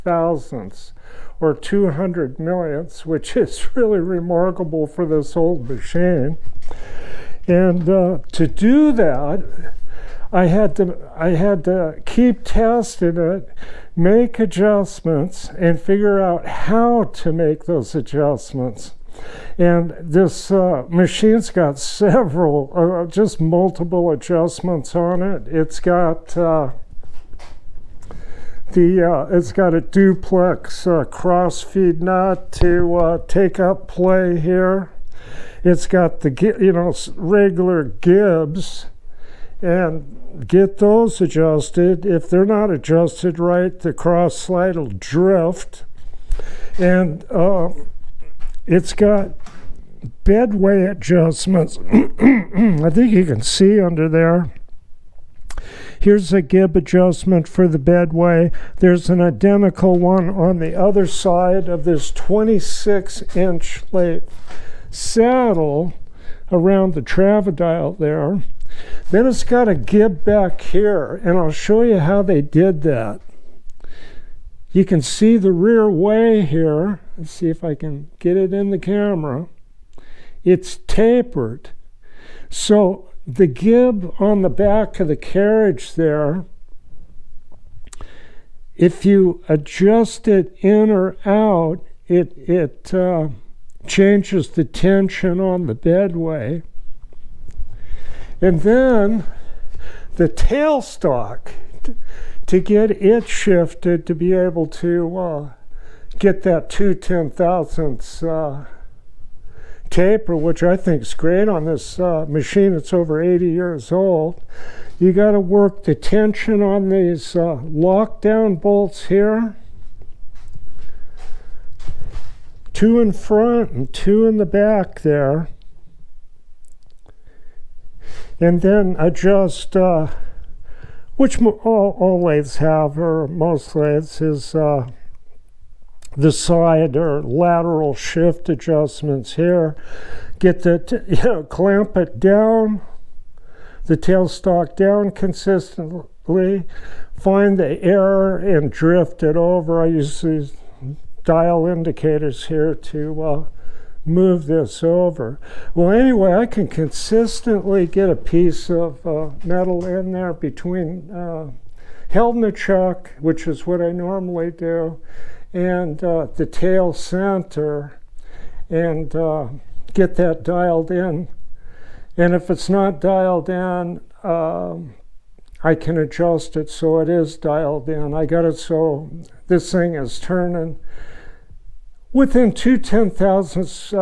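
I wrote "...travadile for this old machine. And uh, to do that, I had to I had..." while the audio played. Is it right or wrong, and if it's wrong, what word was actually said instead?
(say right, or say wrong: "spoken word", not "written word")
wrong: "remarkable", not "travadile".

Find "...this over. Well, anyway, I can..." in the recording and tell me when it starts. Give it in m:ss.
2:34.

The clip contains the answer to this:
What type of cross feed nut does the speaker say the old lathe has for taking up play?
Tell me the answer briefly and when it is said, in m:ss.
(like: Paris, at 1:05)
duplex, at 0:29.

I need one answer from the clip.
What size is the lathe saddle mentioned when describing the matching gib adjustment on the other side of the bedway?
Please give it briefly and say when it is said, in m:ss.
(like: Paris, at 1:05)
26 inch, at 1:02.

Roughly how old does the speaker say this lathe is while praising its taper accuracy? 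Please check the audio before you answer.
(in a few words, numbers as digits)
over 80 years.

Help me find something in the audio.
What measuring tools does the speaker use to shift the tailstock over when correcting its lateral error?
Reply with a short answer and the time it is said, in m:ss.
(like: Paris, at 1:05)
dial indicators, at 2:31.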